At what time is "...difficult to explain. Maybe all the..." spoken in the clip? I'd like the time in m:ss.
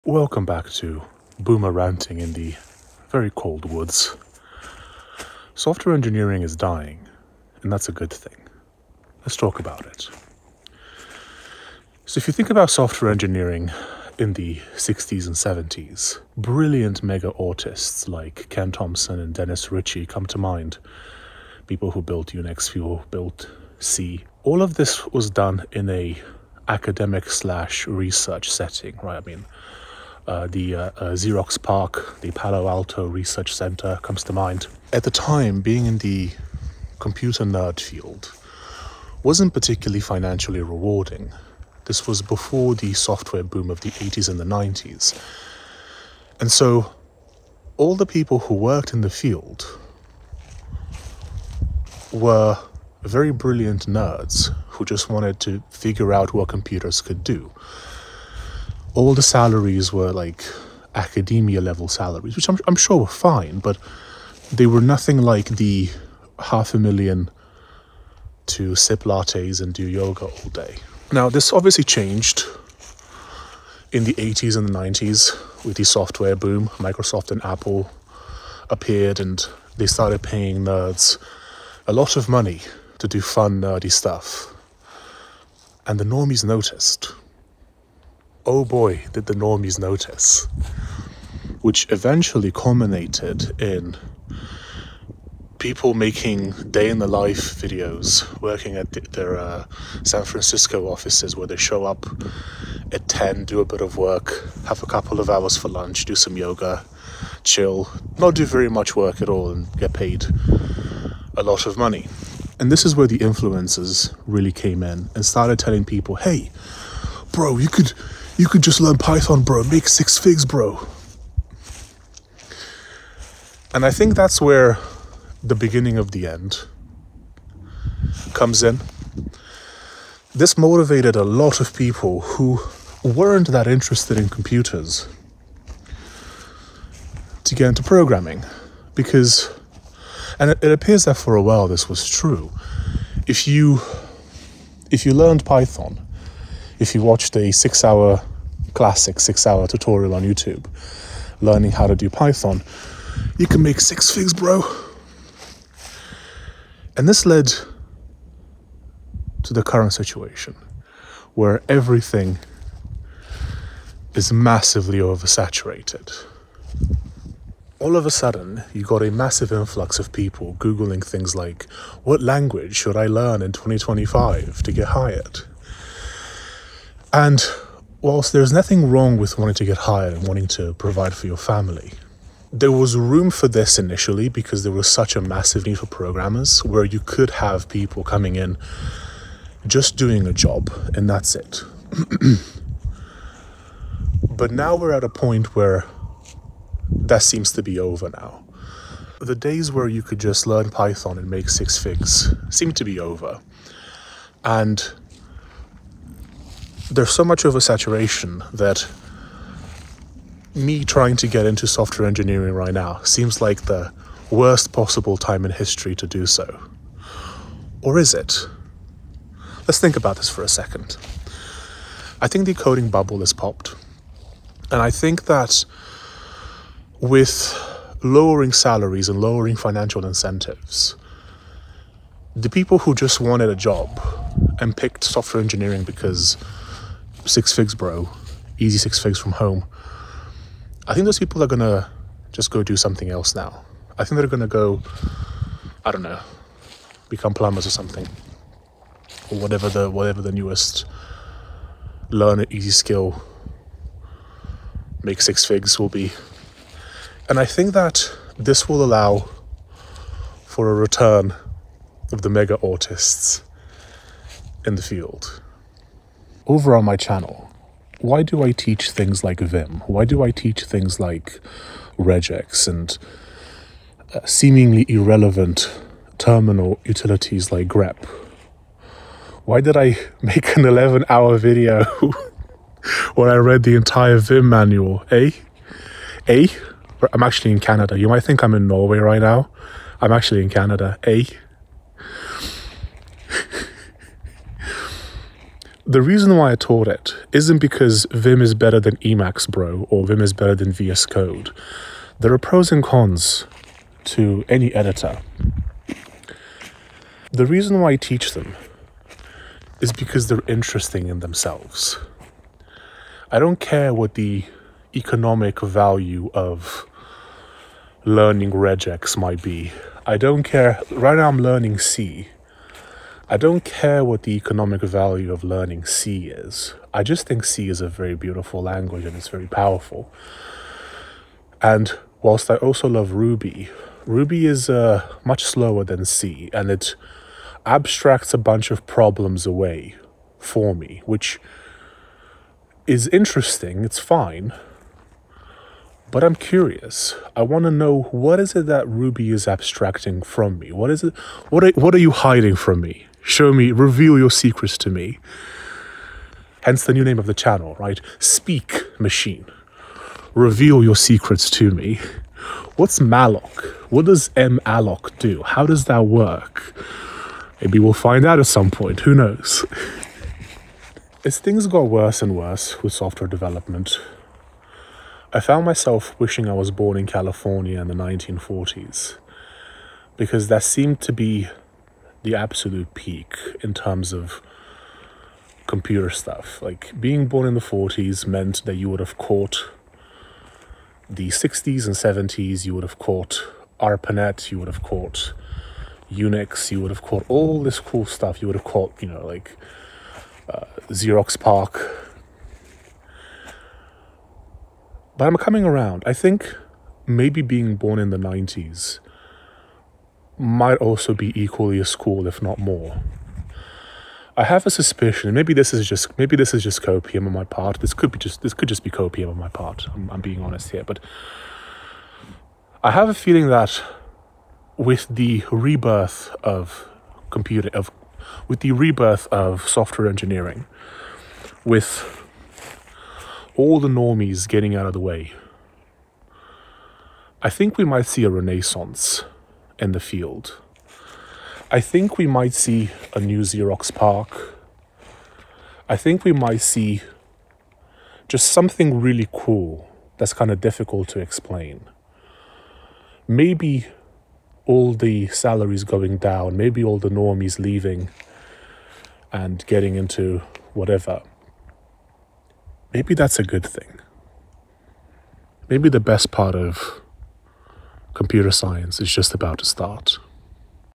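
7:30.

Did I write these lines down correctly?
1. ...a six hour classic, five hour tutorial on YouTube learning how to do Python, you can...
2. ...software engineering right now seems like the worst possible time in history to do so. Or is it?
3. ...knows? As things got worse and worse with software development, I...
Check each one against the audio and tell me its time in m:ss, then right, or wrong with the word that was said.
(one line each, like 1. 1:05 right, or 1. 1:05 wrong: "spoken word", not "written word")
1. 2:27 wrong: "six", not "five"
2. 3:31 right
3. 6:09 right.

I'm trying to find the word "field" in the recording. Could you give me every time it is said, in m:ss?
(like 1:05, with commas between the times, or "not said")
0:37, 0:49, 4:24, 7:19.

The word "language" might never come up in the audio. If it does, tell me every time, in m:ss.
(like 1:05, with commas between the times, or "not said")
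2:52, 5:28.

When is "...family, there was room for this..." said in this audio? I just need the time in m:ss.
3:01.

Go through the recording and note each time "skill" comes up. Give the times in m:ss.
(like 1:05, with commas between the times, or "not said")
4:12.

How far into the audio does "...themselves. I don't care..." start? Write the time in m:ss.
5:11.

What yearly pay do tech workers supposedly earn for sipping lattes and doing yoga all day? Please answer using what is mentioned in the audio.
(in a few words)
half a million.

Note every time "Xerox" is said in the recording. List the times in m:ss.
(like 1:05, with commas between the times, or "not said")
0:31, 6:40, 7:23.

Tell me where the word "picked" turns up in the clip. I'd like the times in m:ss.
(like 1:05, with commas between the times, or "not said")
3:54.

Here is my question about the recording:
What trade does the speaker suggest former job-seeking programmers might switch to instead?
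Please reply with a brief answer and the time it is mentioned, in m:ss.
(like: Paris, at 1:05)
plumbers, at 4:07.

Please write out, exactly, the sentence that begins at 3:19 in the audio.
The days where you could just learn Python and make six figs seem to be over.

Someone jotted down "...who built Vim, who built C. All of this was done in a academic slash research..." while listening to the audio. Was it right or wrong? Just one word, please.
wrong.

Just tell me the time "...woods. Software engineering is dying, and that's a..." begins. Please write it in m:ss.
0:03.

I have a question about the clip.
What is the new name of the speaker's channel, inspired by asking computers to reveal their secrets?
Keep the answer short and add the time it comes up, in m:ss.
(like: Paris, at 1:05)
Speak Machine, at 5:58.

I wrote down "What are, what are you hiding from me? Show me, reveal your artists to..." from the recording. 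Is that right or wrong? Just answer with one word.
wrong.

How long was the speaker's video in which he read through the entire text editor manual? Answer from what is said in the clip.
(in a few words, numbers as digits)
11 hours.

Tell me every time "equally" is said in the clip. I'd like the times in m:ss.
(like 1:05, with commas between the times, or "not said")
6:51.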